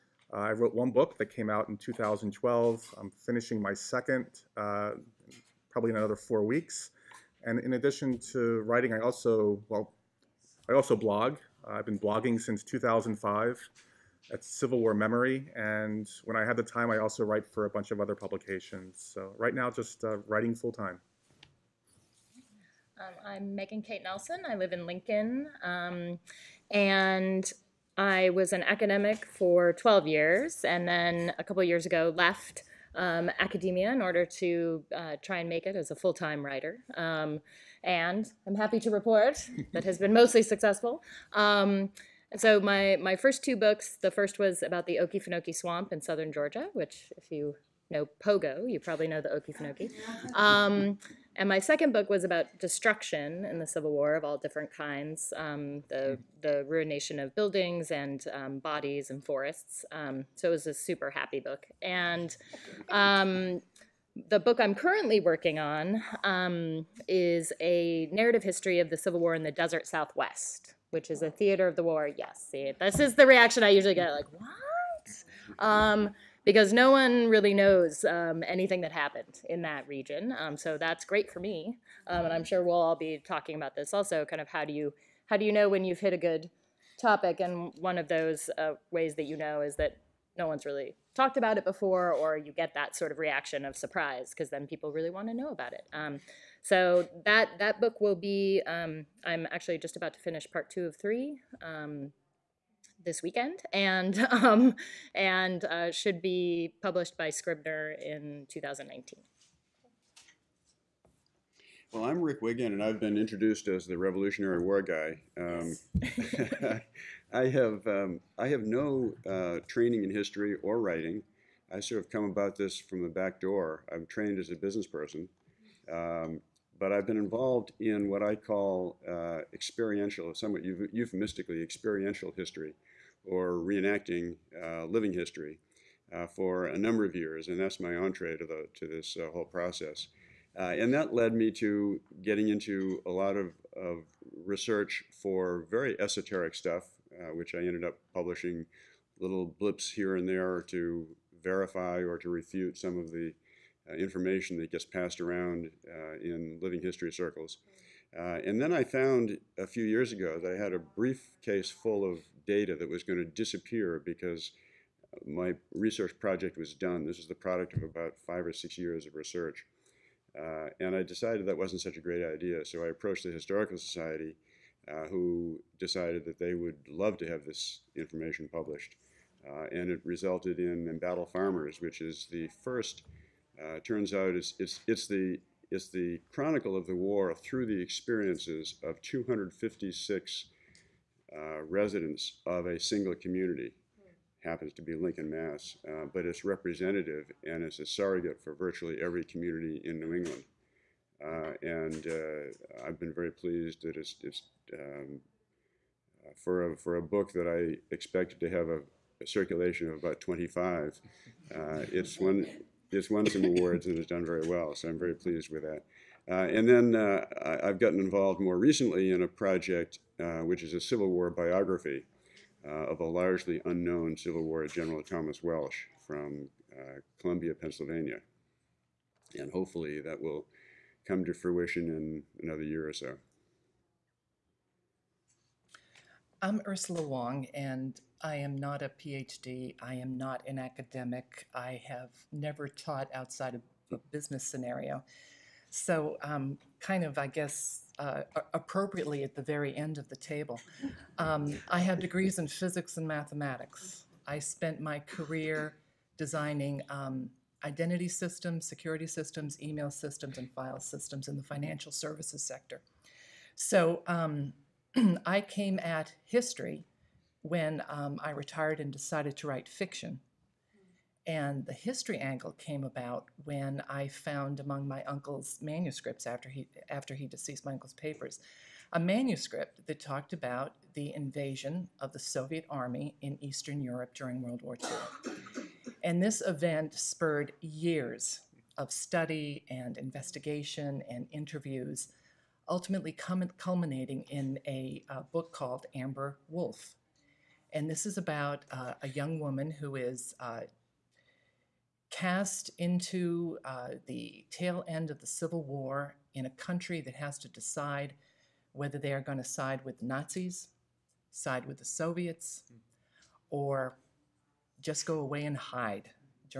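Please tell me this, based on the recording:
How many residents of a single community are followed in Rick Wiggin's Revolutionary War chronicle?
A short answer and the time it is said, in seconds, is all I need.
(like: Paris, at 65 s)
256, at 188 s.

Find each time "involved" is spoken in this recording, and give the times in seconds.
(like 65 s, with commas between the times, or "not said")
127 s, 217 s.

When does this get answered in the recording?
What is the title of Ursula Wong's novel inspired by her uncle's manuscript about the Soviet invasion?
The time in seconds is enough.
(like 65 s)
295 s.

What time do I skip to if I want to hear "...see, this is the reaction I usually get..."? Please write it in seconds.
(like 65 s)
72 s.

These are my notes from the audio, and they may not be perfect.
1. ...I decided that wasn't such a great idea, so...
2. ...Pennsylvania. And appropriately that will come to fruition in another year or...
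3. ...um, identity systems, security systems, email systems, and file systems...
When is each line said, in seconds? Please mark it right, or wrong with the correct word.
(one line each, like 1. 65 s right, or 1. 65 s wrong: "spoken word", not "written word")
1. 170 s right
2. 227 s wrong: "hopefully", not "appropriately"
3. 256 s right.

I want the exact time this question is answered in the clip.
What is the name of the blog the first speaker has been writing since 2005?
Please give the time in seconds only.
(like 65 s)
14 s.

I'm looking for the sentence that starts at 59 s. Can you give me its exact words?
Um, so it was a super happy book.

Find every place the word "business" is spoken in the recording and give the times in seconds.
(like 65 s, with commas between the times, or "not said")
124 s, 244 s.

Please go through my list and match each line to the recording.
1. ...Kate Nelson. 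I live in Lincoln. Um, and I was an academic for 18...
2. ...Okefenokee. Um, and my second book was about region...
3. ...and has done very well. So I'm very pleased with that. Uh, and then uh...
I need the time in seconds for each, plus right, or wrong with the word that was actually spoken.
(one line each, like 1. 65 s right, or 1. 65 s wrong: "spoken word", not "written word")
1. 23 s wrong: "12", not "18"
2. 49 s wrong: "destruction", not "region"
3. 213 s right.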